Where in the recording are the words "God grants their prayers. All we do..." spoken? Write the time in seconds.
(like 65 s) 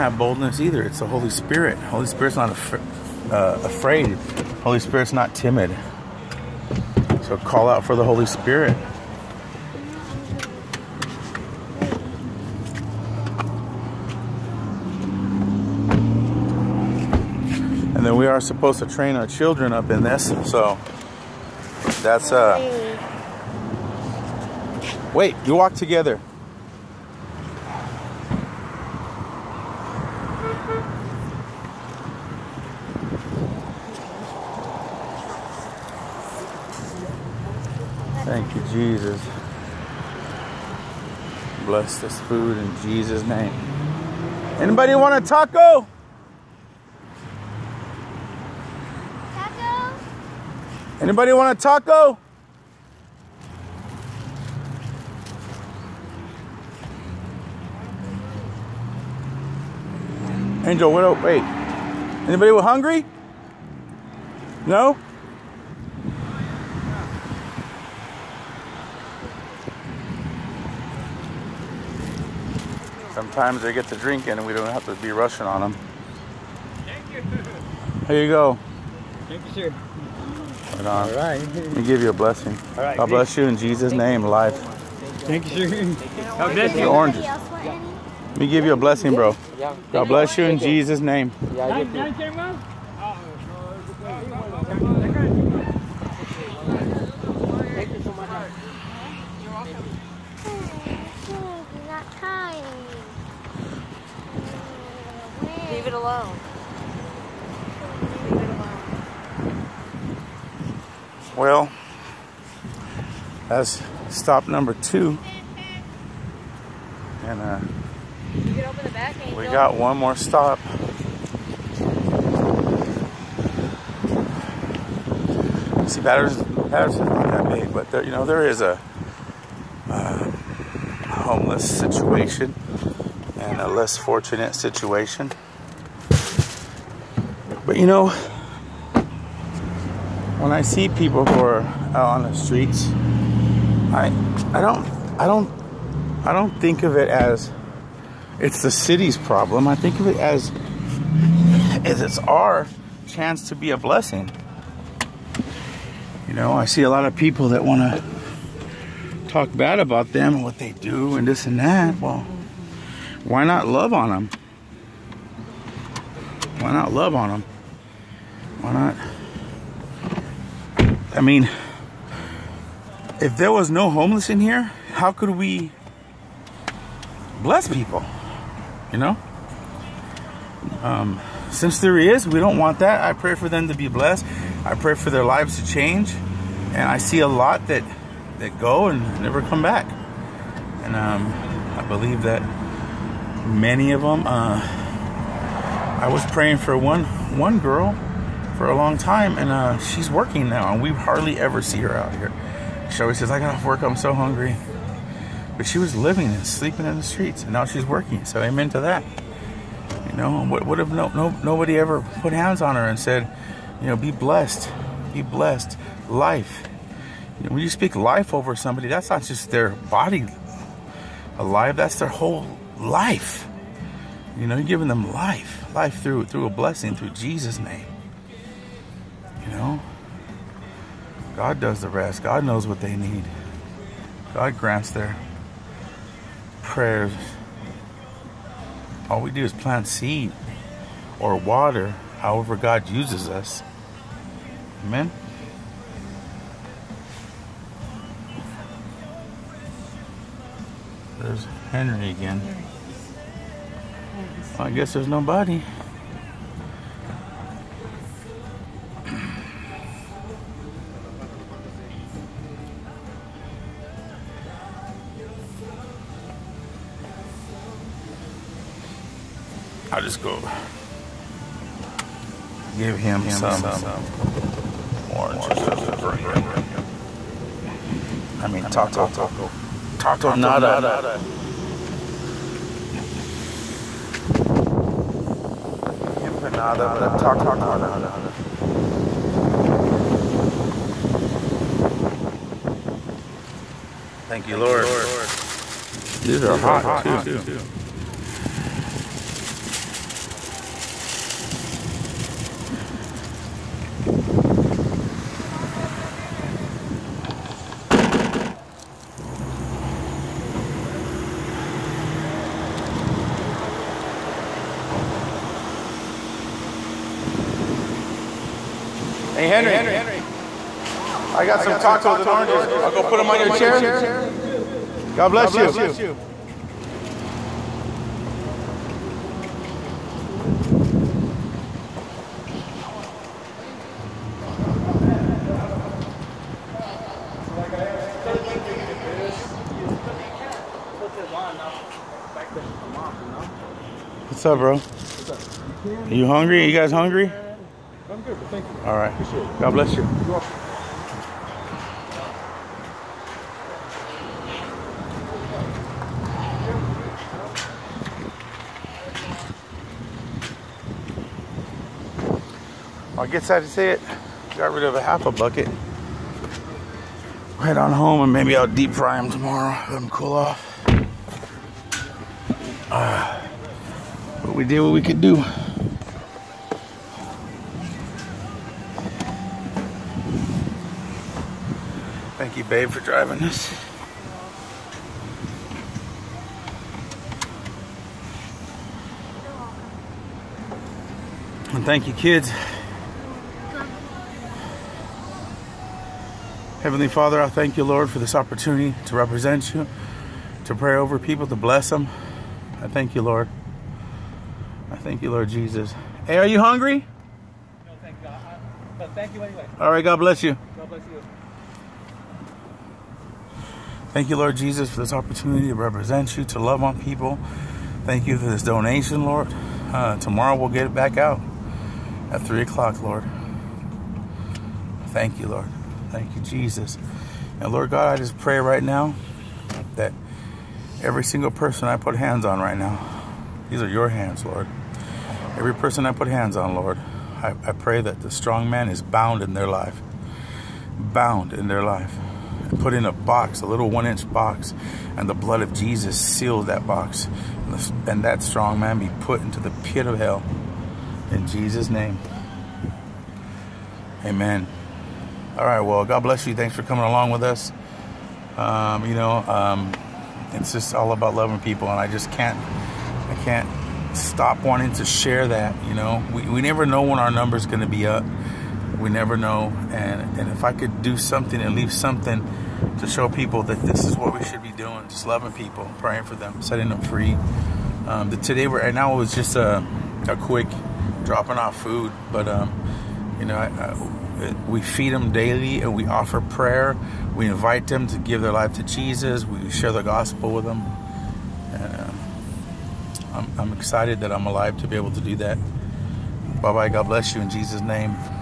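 234 s.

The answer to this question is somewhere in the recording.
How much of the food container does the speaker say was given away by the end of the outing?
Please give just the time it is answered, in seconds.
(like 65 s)
365 s.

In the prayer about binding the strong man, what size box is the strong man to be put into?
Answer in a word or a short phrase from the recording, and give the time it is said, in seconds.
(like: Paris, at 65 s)
one inch, at 443 s.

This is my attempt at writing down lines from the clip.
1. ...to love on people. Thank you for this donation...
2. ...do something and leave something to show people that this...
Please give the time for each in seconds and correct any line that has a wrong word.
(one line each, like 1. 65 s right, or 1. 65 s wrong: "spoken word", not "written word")
1. 416 s right
2. 471 s right.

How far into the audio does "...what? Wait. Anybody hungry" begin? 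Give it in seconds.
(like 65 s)
60 s.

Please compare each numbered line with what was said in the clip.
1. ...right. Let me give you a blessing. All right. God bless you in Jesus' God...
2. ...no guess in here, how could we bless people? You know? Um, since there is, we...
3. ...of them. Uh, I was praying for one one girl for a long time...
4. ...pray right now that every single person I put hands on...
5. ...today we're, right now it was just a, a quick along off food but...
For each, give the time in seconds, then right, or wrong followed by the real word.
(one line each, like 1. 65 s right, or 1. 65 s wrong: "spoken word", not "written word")
1. 81 s wrong: "Thank", not "God"
2. 173 s wrong: "homeless", not "guess"
3. 193 s right
4. 428 s right
5. 478 s wrong: "dropping", not "along".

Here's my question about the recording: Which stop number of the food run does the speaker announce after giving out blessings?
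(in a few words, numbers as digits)
2.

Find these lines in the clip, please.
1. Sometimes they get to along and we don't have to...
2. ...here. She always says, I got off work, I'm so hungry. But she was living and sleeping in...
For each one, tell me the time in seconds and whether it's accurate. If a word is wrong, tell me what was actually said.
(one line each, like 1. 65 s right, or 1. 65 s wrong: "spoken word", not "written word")
1. 73 s wrong: "drinking", not "along"
2. 202 s right.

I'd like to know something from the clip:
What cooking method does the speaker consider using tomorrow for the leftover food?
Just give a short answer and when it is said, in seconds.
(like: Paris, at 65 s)
deep fry, at 368 s.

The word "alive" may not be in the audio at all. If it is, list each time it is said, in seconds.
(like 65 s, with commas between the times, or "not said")
221 s, 494 s.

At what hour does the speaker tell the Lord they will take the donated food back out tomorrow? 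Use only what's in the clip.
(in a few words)
3 o'clock.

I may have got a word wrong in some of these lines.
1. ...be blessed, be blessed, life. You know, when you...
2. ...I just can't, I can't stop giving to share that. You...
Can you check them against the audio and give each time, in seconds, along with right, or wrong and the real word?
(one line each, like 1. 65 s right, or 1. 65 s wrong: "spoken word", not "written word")
1. 213 s right
2. 461 s wrong: "wanting", not "giving".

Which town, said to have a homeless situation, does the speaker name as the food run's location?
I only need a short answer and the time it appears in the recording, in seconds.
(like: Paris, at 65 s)
Patterson, at 126 s.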